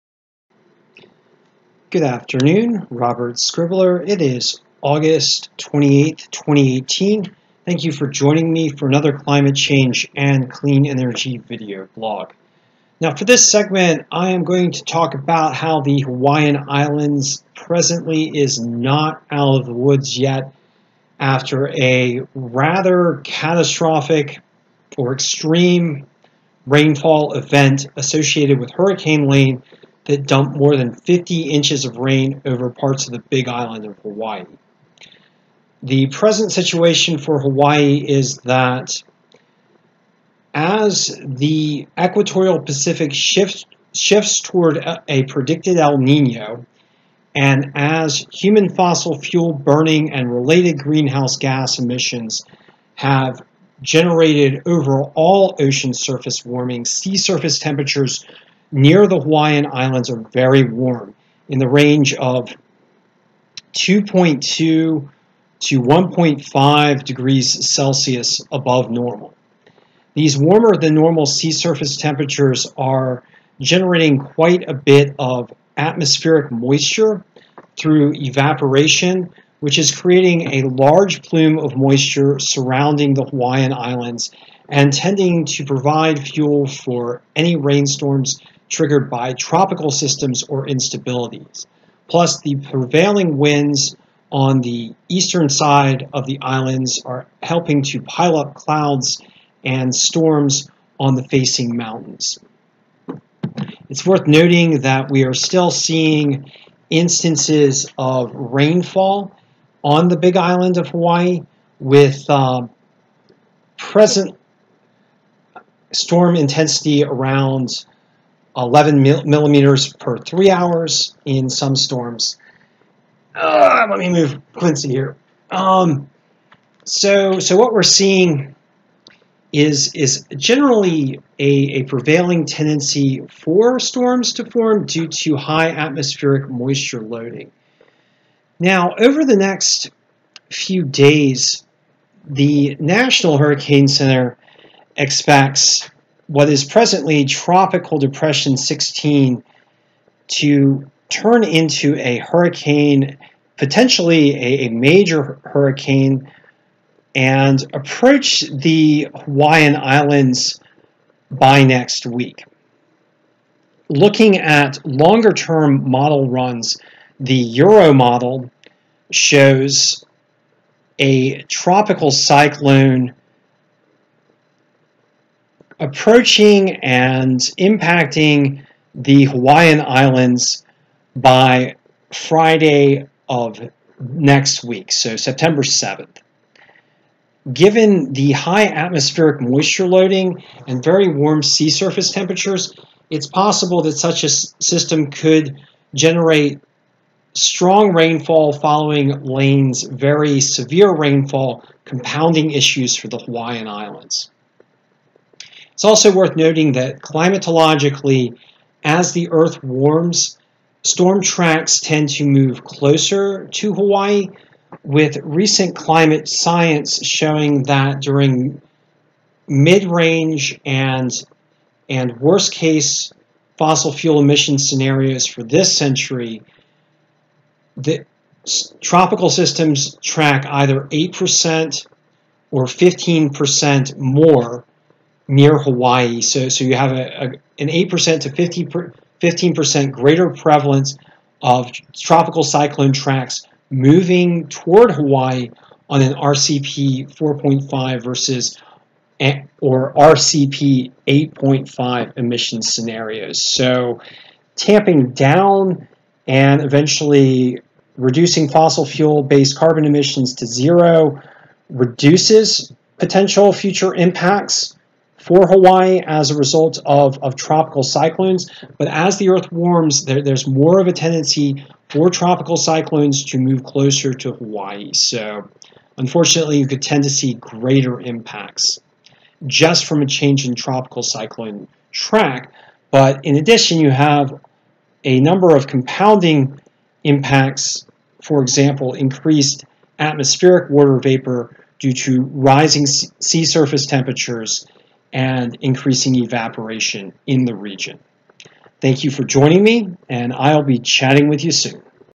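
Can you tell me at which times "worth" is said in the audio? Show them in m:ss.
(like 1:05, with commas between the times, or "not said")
1:44, 3:26.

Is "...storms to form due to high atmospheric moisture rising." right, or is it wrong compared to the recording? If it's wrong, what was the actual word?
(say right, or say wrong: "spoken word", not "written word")
wrong: "loading", not "rising".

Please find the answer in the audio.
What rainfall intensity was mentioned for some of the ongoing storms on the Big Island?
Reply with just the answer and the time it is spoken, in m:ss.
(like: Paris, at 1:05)
11 millimeters per three hours, at 1:58.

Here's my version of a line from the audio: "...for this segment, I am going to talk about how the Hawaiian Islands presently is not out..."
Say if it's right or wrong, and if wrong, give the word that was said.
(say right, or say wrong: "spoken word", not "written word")
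right.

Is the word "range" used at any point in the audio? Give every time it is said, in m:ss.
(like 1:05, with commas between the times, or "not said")
1:01, 3:39.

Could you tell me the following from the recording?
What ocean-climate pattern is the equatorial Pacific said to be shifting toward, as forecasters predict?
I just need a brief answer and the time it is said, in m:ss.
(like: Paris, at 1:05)
El Nino, at 0:45.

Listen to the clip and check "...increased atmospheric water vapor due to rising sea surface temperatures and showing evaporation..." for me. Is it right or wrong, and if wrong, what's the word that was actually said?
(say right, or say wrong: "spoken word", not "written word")
wrong: "increasing", not "showing".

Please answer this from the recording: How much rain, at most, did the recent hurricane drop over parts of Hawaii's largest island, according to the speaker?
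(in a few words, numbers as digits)
more than 50 inches.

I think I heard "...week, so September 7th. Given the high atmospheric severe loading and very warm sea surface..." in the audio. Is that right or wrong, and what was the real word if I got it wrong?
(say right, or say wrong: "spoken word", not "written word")
wrong: "moisture", not "severe".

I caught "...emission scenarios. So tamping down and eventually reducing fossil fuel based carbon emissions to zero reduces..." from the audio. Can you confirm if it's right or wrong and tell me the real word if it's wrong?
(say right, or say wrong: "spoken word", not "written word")
right.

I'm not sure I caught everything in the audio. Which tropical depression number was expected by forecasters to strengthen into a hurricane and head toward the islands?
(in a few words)
16.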